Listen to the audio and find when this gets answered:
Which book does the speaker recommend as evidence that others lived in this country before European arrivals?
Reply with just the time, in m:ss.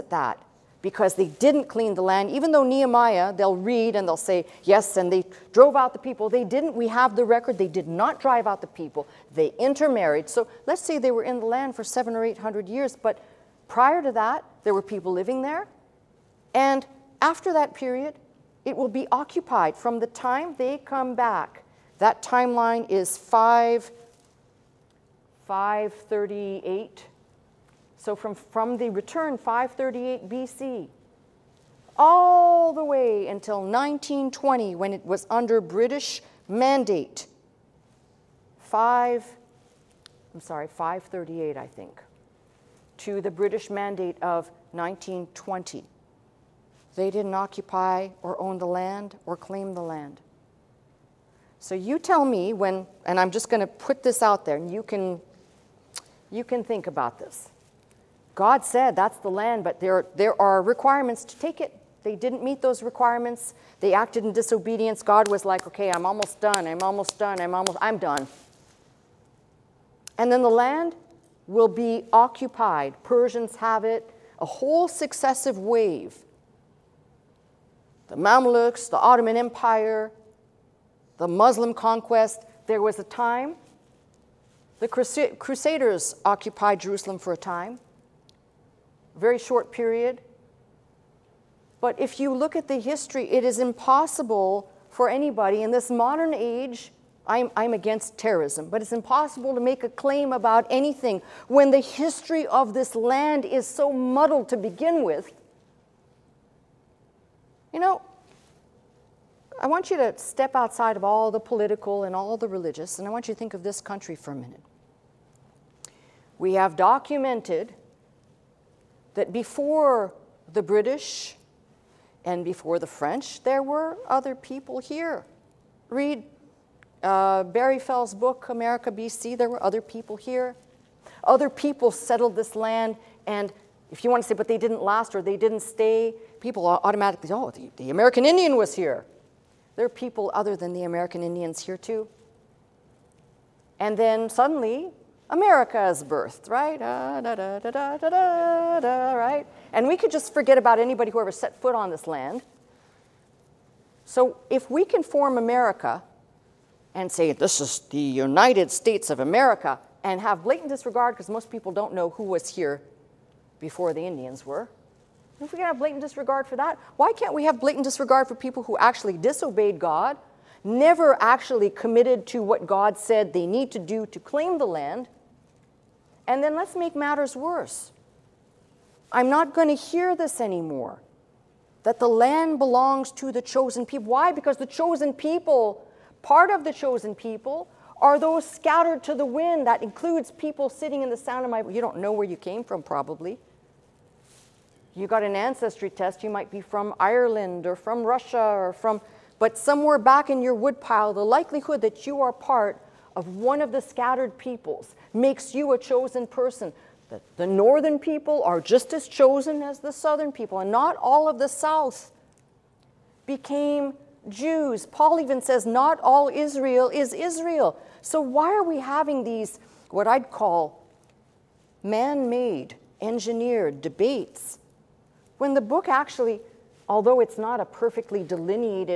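2:08.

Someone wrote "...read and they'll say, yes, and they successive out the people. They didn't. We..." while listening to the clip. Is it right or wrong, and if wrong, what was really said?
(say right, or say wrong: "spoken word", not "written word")
wrong: "drove", not "successive".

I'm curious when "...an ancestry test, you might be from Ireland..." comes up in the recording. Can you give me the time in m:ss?
3:15.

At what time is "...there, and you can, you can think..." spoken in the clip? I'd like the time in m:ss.
0:54.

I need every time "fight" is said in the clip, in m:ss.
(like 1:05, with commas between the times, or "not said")
not said.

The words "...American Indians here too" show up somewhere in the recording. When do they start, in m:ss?
2:20.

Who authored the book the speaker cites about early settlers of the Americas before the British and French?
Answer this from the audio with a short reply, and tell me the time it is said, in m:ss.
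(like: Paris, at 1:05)
Barry Fell, at 2:07.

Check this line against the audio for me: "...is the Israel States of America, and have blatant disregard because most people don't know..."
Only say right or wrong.
wrong.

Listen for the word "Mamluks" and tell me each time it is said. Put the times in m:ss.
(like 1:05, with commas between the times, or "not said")
1:18.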